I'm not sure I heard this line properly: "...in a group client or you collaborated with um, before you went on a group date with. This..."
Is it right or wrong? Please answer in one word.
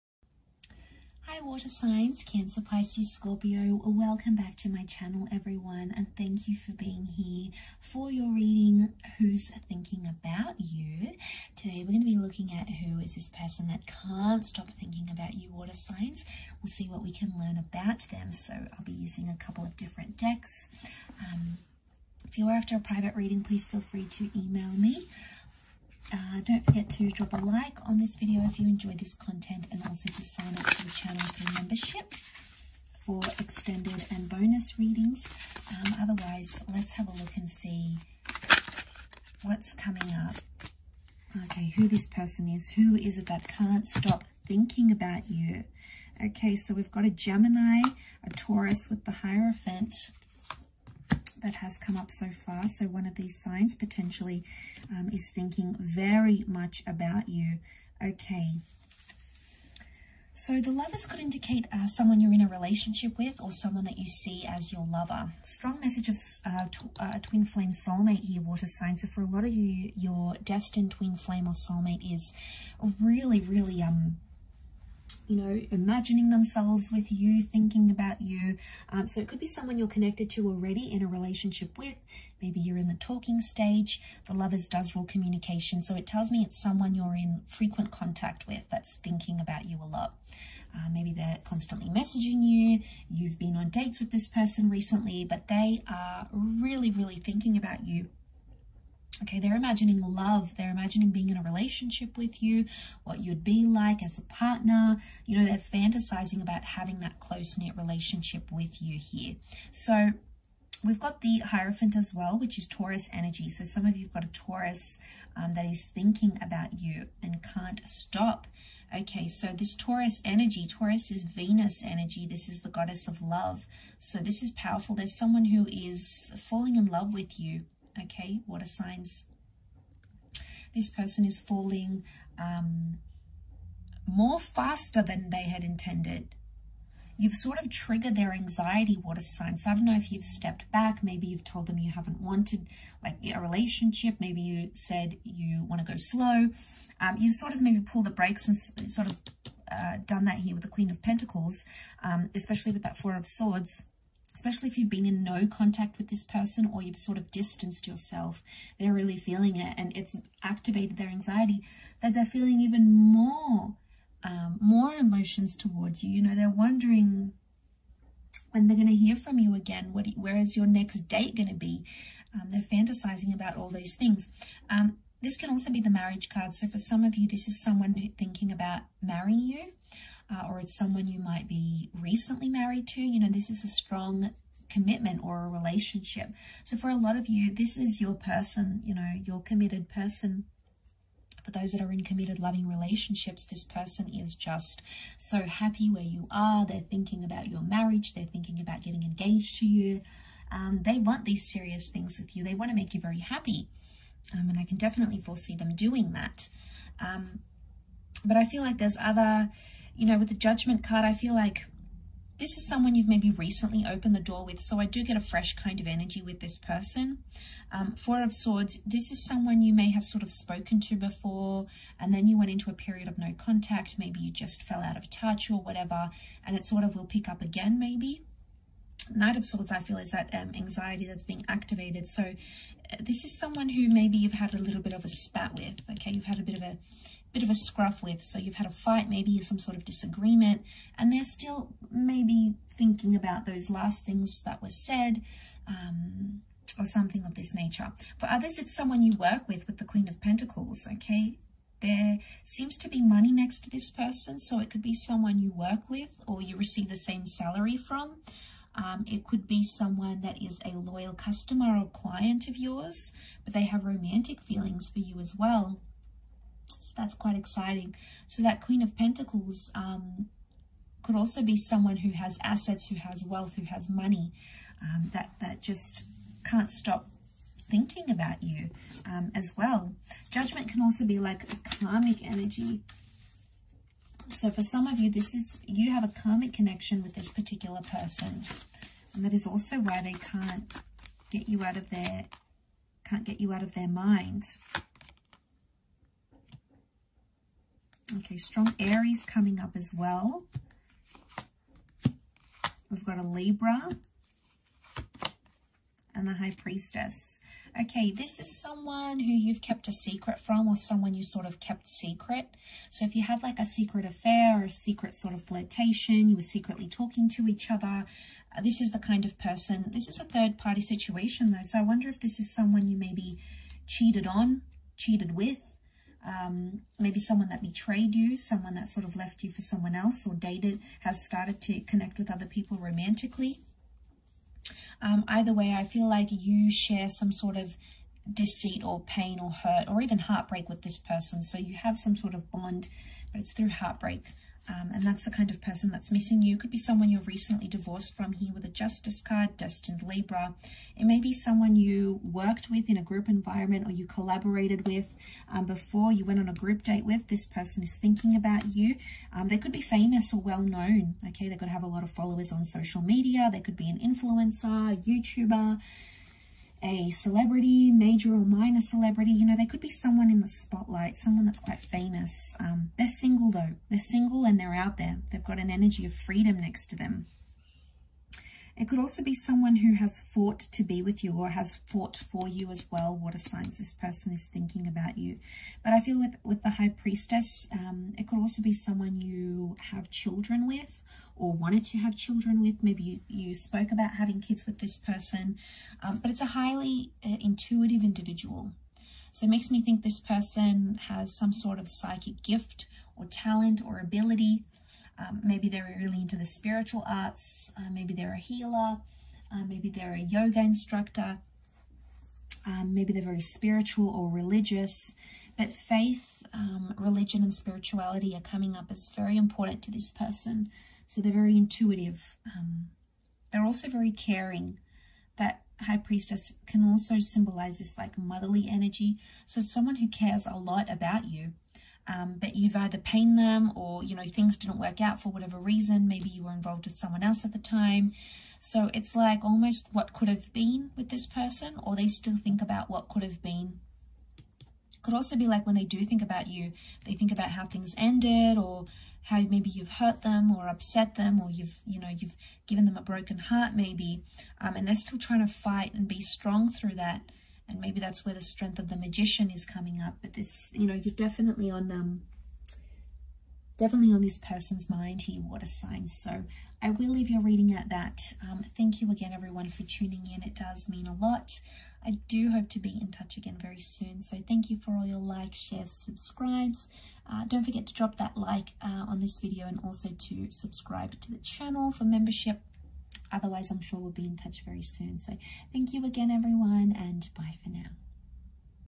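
wrong.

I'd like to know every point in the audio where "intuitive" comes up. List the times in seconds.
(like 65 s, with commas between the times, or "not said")
397 s, 421 s.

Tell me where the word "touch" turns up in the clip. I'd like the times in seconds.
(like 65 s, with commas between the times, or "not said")
225 s, 473 s, 484 s.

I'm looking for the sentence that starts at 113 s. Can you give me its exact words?
So some of you've got a Taurus um, that is thinking about you and can't stop.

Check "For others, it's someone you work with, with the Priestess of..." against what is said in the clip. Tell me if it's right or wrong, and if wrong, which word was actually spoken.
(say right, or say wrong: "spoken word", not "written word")
wrong: "Queen", not "Priestess".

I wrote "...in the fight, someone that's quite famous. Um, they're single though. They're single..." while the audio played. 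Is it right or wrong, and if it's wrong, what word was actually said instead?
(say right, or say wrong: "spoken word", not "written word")
wrong: "spotlight", not "fight".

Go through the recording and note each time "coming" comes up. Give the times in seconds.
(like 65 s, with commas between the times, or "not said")
39 s, 299 s, 418 s, 459 s.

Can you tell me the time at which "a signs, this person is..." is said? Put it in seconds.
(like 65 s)
383 s.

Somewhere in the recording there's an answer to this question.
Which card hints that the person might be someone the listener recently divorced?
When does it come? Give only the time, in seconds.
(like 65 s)
348 s.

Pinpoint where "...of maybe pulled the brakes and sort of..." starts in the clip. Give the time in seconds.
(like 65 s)
147 s.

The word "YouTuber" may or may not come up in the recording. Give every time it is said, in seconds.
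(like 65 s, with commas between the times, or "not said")
365 s.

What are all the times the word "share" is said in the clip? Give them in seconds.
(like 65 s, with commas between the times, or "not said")
336 s, 475 s.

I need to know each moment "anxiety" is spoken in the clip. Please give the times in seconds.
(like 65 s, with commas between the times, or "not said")
138 s, 161 s, 230 s.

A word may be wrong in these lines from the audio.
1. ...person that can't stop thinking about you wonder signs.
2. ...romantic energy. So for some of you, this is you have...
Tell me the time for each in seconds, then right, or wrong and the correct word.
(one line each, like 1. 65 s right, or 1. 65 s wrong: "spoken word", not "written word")
1. 13 s wrong: "water", not "wonder"
2. 281 s wrong: "karmic", not "romantic".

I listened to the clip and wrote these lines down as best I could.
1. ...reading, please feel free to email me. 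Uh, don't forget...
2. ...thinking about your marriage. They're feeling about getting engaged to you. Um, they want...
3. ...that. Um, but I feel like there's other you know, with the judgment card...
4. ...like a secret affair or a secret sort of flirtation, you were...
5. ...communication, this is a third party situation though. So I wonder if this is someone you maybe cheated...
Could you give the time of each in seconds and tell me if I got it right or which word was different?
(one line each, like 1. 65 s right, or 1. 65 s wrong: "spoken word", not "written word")
1. 23 s right
2. 196 s wrong: "thinking", not "feeling"
3. 206 s right
4. 313 s right
5. 319 s wrong: "person", not "communication".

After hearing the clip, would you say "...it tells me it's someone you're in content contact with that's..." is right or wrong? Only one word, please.
wrong.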